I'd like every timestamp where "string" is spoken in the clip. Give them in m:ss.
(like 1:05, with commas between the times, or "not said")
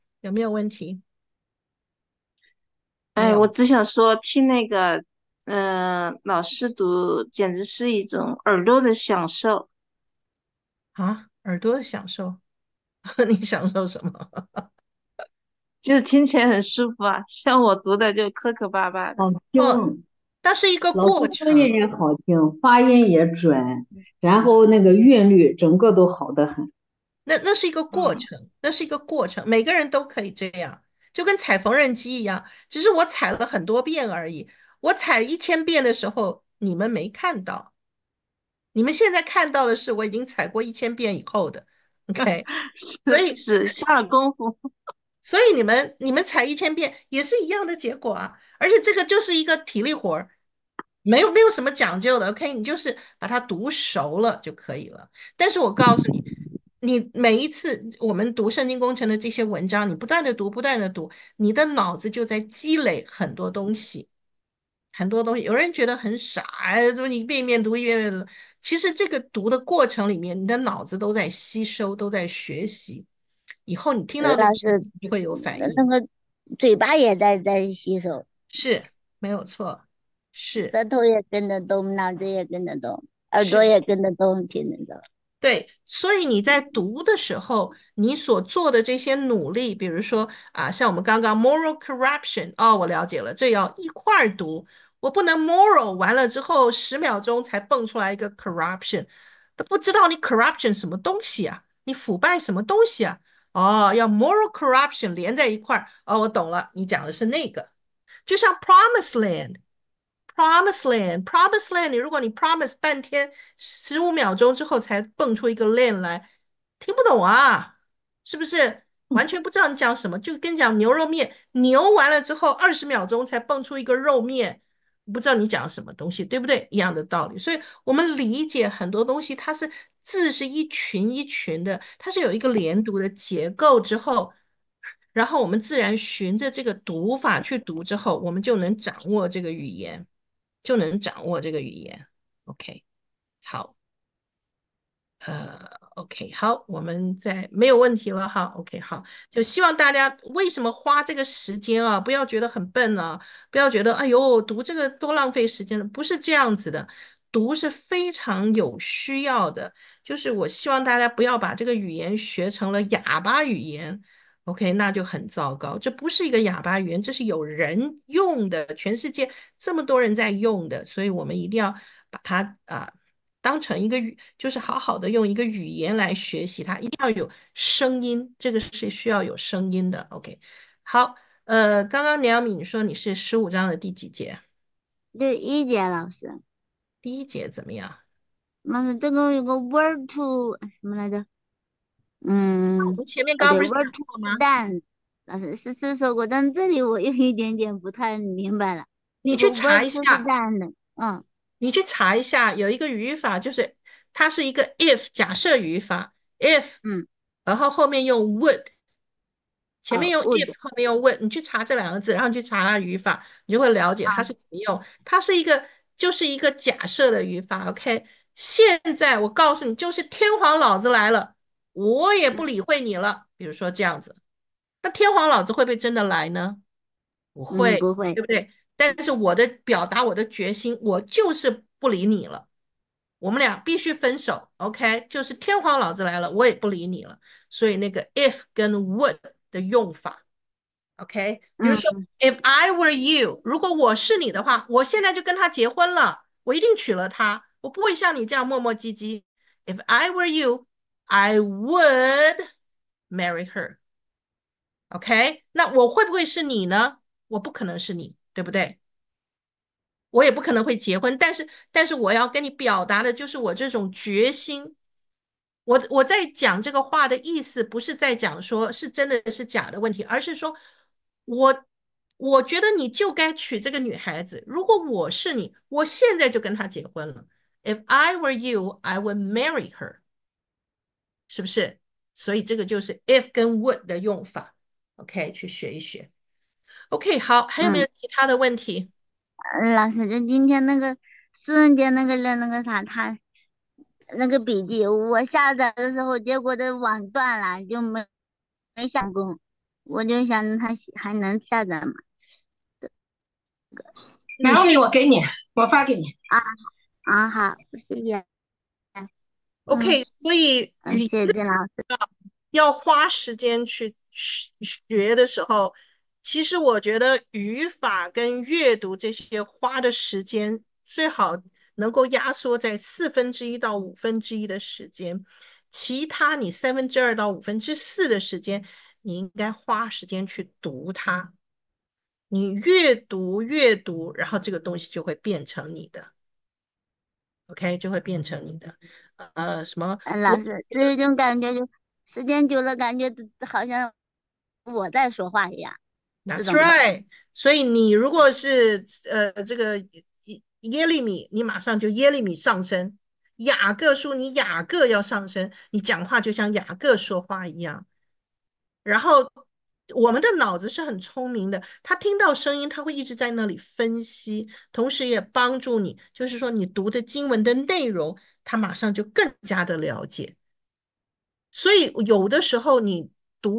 not said.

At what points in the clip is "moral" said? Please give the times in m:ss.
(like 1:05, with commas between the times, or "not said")
1:31, 1:35, 1:44.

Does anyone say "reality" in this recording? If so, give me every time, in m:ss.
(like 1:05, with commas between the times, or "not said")
not said.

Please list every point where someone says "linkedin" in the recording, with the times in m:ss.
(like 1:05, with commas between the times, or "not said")
not said.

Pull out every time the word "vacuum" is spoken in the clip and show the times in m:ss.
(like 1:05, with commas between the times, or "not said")
not said.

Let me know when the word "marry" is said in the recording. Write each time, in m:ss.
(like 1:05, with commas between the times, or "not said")
4:13, 4:39.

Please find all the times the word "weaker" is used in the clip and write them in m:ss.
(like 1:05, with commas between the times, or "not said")
not said.